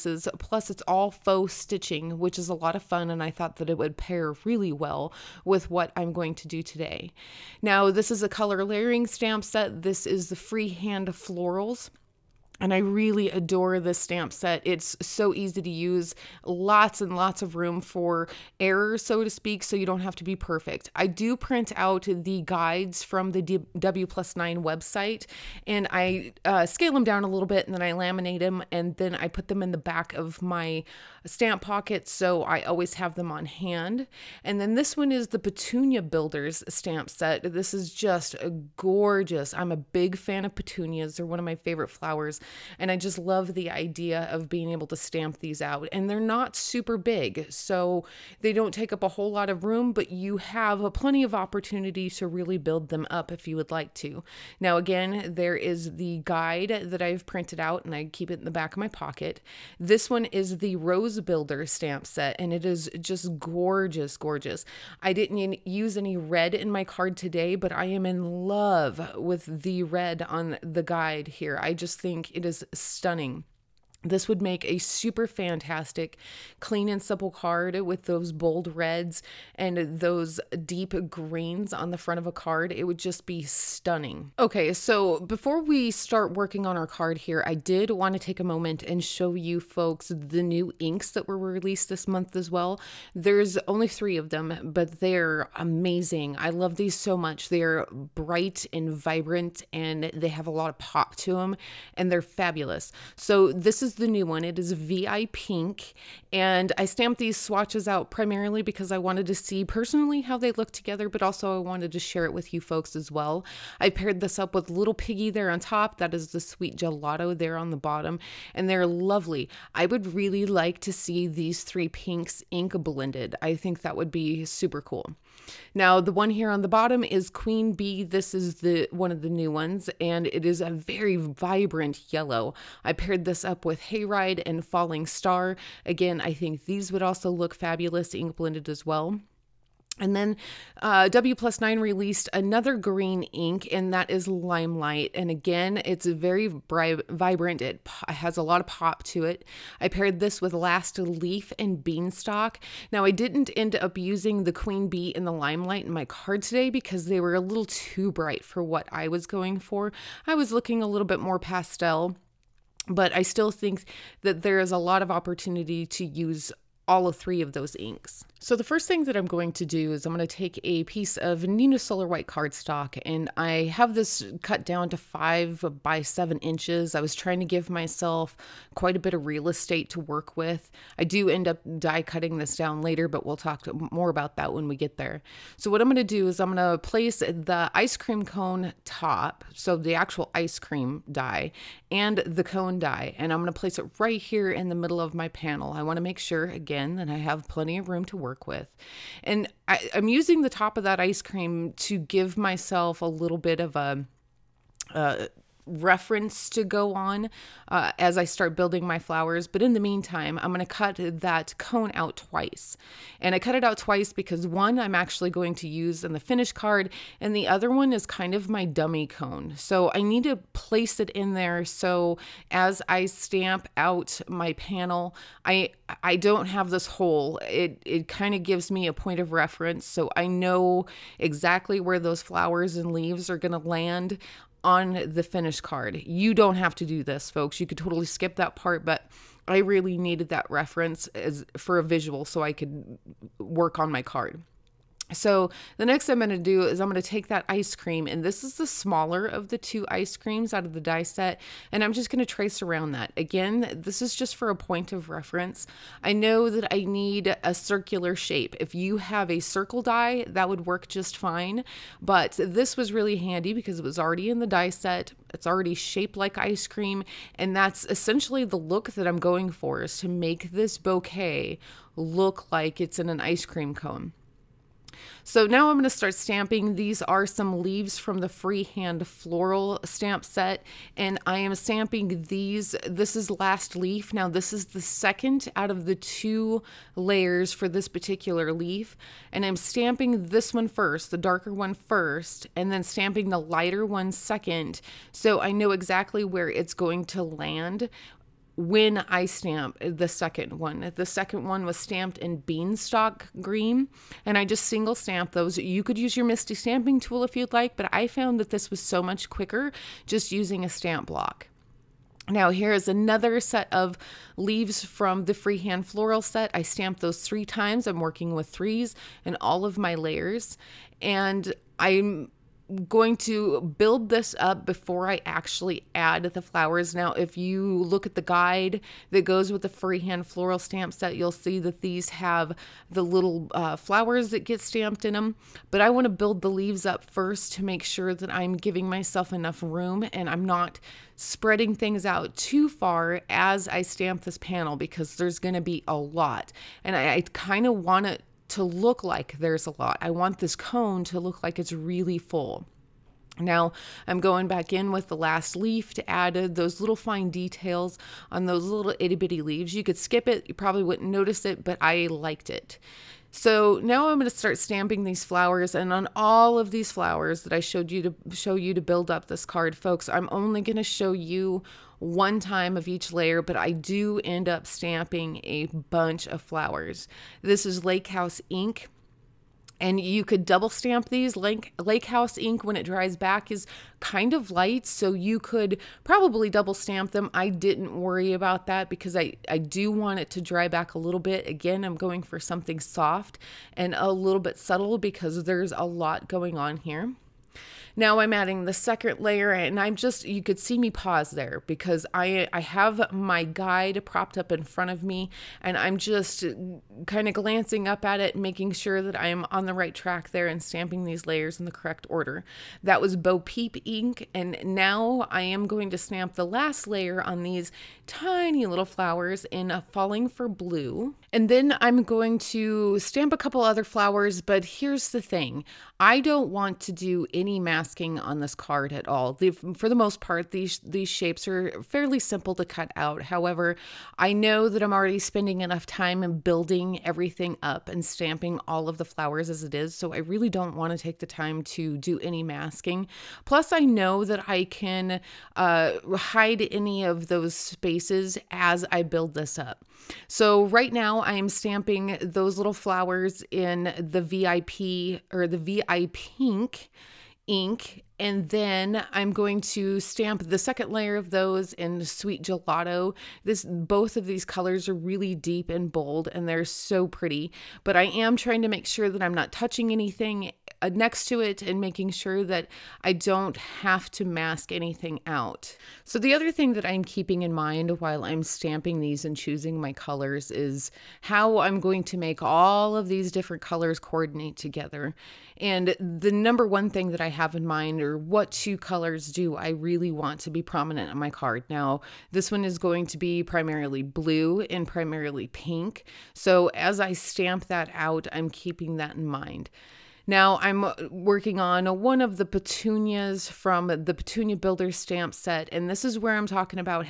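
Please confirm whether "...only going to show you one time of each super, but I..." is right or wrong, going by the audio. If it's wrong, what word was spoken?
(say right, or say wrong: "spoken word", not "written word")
wrong: "layer", not "super".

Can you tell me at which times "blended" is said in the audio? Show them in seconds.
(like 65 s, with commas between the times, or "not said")
122 s, 138 s.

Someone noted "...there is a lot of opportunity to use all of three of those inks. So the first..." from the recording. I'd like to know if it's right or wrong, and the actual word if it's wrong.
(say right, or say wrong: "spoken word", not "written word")
right.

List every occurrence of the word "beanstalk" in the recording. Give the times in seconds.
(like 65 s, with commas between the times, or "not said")
151 s, 302 s.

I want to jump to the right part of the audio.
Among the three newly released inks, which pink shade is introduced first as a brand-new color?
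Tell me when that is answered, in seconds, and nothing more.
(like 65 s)
104 s.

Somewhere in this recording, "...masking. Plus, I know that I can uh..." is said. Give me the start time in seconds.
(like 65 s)
442 s.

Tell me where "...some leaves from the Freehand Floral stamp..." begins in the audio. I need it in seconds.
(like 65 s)
277 s.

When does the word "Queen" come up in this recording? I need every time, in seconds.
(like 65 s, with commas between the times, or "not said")
127 s, 154 s.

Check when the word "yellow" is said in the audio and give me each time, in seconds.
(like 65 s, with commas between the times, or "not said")
132 s.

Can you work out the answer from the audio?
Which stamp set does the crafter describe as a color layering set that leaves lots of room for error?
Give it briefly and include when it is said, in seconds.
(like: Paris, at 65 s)
Freehand Florals, at 10 s.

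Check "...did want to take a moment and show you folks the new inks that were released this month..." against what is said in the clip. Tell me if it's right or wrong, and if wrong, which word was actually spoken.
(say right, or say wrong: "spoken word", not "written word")
right.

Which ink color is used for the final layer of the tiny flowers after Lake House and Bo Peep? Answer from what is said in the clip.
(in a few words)
Falling for Blue.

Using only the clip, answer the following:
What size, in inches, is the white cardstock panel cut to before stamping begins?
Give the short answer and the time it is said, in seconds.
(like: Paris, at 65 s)
5 by 7 inches, at 174 s.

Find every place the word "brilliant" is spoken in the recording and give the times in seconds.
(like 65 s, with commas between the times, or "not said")
not said.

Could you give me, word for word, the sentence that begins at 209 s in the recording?
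But in the meantime, I'm going to cut that cone out twice.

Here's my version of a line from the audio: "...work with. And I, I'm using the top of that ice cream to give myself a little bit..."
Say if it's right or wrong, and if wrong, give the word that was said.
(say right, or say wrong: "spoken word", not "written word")
right.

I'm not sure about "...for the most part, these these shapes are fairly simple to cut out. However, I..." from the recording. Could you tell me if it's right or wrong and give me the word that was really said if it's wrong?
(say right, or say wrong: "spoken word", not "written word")
right.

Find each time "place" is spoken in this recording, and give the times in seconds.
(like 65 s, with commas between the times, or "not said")
186 s, 193 s, 220 s.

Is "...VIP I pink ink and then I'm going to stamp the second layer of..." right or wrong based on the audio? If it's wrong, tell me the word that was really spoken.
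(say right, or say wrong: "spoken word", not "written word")
right.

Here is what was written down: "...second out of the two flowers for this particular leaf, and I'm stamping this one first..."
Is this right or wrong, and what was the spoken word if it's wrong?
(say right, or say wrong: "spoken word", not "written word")
wrong: "layers", not "flowers".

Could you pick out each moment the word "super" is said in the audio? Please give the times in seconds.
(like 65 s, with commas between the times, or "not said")
46 s, 74 s, 124 s.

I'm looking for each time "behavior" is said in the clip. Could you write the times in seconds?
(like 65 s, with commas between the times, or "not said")
not said.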